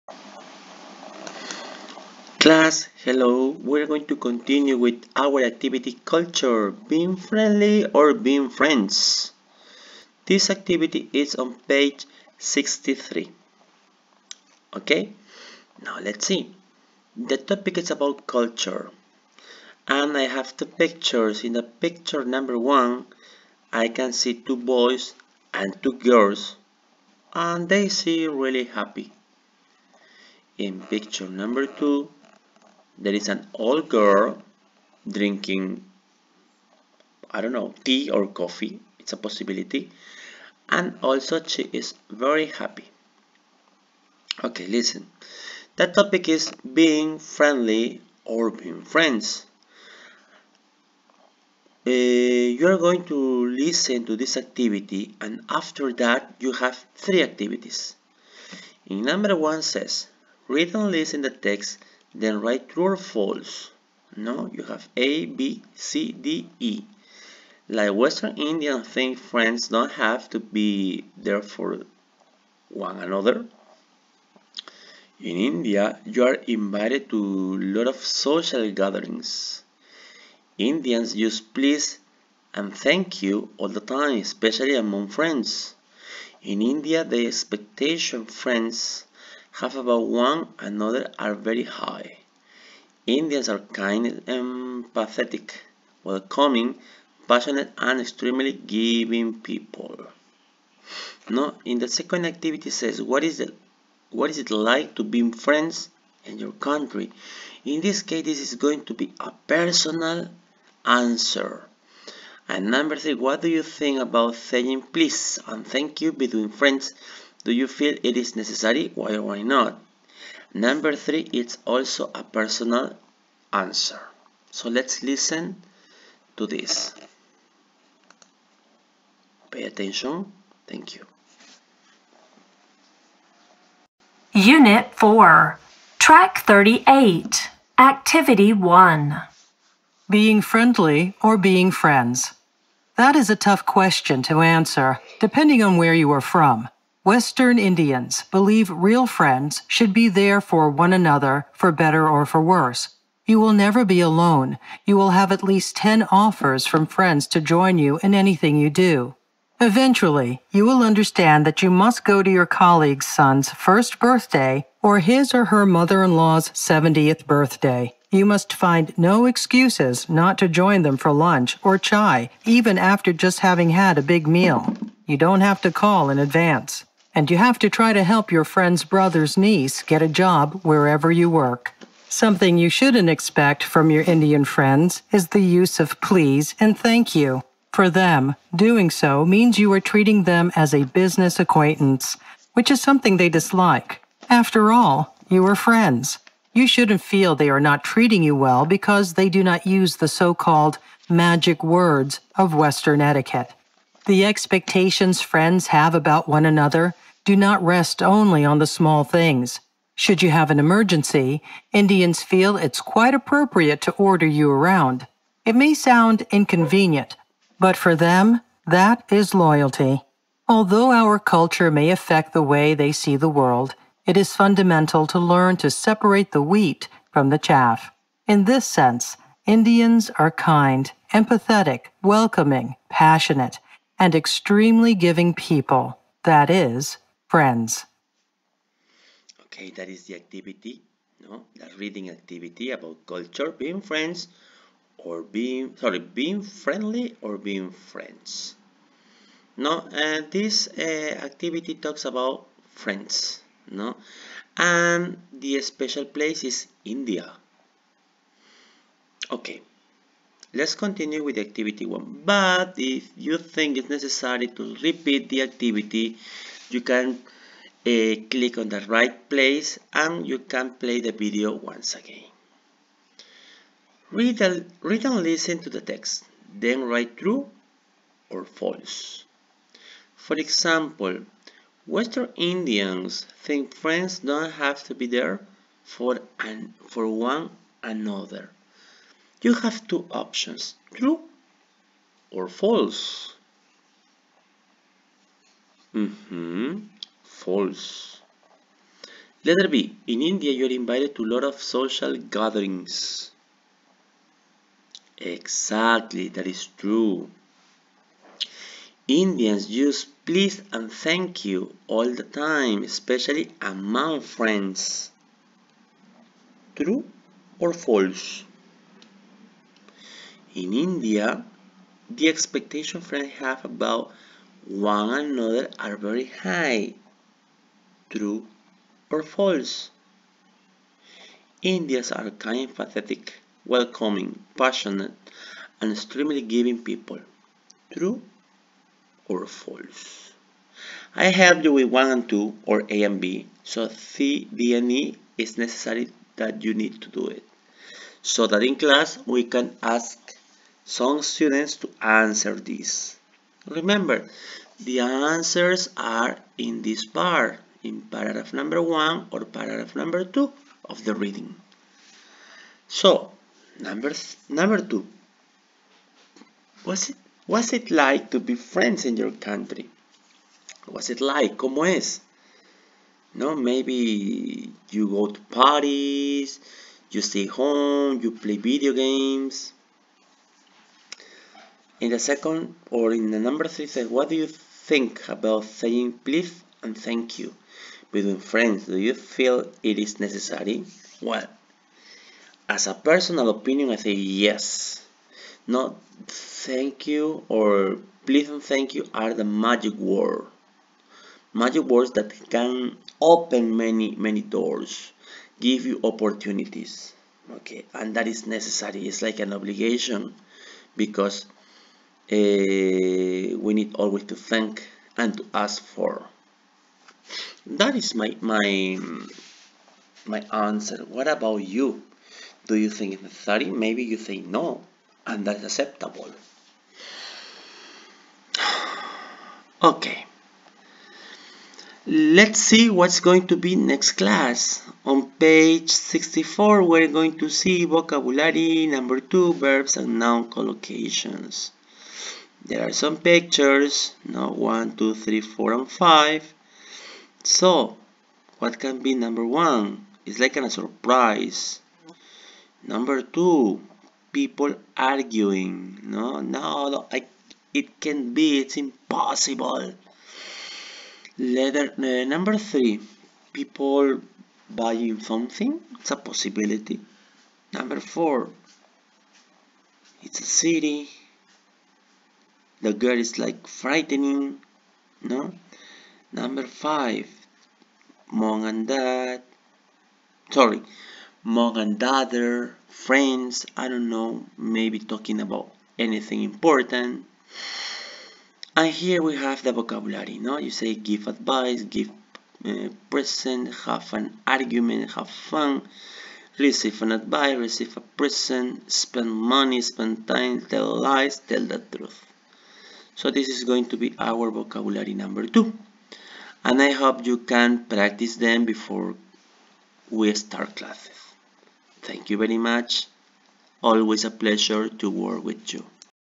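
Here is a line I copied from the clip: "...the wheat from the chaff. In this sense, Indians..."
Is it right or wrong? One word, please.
right.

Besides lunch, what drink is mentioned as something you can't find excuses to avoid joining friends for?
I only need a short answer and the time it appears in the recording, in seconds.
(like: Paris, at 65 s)
Chai, at 171 s.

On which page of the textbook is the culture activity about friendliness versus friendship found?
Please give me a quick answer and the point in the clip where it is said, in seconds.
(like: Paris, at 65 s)
63, at 11 s.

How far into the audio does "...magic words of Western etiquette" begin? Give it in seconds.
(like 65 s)
201 s.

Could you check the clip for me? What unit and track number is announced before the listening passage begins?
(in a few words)
Unit 4, Track 38.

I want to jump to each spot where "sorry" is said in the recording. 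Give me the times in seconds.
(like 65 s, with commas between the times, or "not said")
245 s, 480 s.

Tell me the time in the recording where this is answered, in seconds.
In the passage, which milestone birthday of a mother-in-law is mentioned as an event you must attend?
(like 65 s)
166 s.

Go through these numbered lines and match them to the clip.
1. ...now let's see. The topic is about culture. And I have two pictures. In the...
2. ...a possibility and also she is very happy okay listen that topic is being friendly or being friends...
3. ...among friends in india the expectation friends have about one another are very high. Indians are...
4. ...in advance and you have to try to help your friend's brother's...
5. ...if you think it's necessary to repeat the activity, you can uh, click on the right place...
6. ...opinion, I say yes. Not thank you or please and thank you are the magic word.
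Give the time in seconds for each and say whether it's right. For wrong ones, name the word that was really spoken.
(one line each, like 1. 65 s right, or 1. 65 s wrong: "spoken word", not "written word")
1. 15 s right
2. 39 s right
3. 84 s right
4. 176 s right
5. 262 s right
6. 393 s right.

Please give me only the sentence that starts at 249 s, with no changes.
No, uh, this uh, activity talks about friends, no?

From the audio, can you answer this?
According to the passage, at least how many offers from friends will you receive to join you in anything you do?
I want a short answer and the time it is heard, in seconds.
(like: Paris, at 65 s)
10, at 155 s.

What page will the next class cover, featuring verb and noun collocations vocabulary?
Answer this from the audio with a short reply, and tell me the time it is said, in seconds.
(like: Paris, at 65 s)
64, at 435 s.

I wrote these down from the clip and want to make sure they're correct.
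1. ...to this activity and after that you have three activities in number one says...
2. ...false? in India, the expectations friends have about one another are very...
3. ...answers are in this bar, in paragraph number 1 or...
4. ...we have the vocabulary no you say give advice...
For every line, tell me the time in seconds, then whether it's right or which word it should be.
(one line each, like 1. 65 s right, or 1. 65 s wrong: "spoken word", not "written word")
1. 54 s right
2. 317 s right
3. 354 s right
4. 489 s right.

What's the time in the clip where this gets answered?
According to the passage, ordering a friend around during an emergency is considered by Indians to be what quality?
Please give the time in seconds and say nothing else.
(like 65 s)
219 s.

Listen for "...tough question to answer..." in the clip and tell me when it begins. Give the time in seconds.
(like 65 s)
143 s.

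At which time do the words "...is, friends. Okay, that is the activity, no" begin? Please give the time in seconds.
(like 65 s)
236 s.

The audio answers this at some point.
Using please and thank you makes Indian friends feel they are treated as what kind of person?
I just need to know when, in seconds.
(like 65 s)
190 s.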